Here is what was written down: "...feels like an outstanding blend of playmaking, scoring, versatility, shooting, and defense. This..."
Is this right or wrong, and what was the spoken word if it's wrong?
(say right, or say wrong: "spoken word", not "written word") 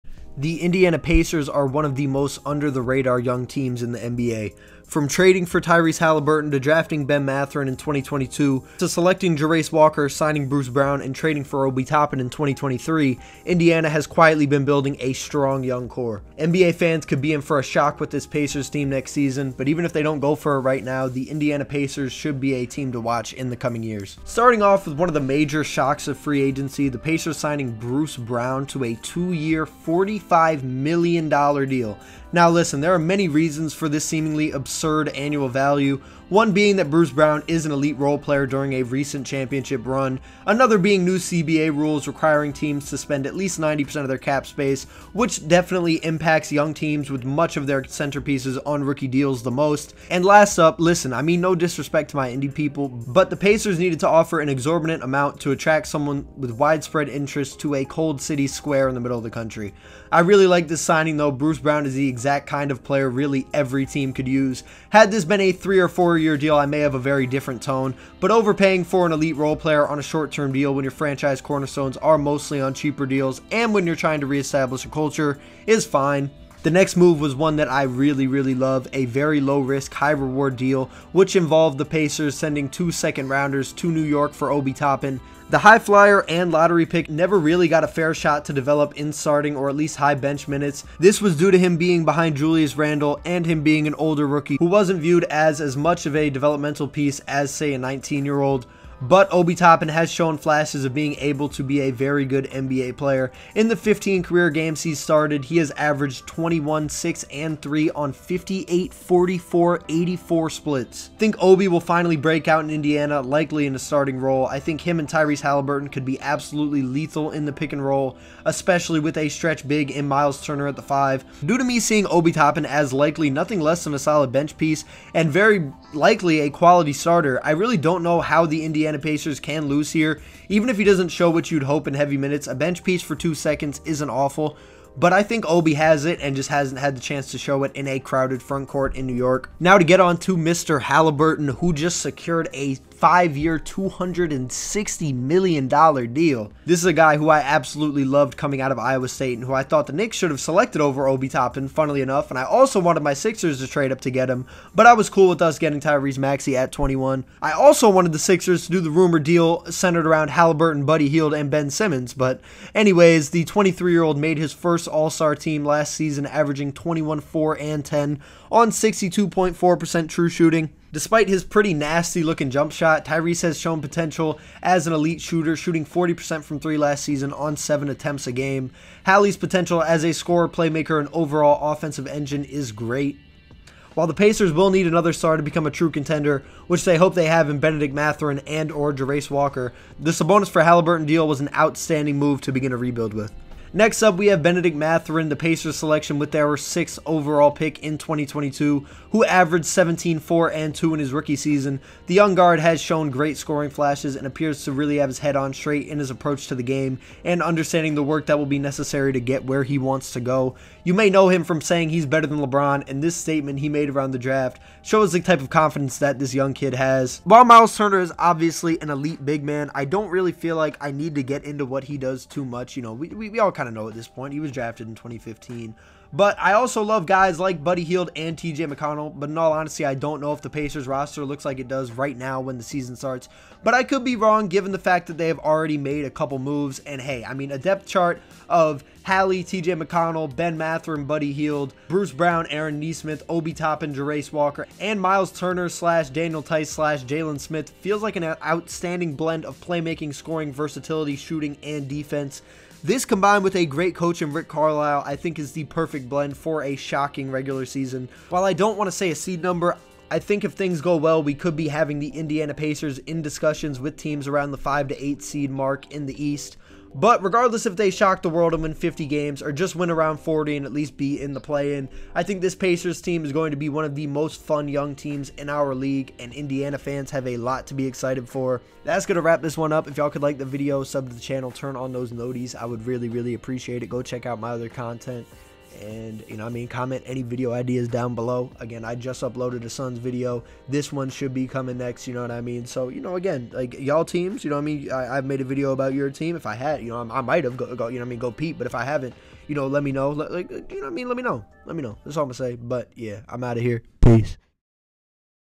right.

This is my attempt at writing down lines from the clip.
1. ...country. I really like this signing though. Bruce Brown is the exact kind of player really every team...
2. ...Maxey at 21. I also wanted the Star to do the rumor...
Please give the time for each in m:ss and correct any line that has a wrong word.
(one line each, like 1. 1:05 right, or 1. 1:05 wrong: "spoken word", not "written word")
1. 0:59 right
2. 2:36 wrong: "Sixers", not "Star".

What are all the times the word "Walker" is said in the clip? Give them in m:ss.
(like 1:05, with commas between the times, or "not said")
0:09, 3:09, 4:04.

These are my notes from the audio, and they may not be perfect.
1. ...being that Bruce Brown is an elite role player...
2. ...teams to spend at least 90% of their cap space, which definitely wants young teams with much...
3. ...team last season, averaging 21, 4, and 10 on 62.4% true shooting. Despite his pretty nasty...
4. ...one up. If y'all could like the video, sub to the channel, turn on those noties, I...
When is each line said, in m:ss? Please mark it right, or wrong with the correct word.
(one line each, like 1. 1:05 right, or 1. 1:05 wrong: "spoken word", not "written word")
1. 0:36 right
2. 0:42 wrong: "impacts", not "wants"
3. 2:45 right
4. 4:39 right.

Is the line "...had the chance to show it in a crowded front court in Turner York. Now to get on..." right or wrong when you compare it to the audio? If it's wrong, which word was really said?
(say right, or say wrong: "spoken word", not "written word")
wrong: "New", not "Turner".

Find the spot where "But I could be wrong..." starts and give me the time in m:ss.
3:53.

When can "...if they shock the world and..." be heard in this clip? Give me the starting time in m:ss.
4:27.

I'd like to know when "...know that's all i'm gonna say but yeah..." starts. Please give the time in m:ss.
5:01.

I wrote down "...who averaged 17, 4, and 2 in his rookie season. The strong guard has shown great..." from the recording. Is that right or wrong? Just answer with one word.
wrong.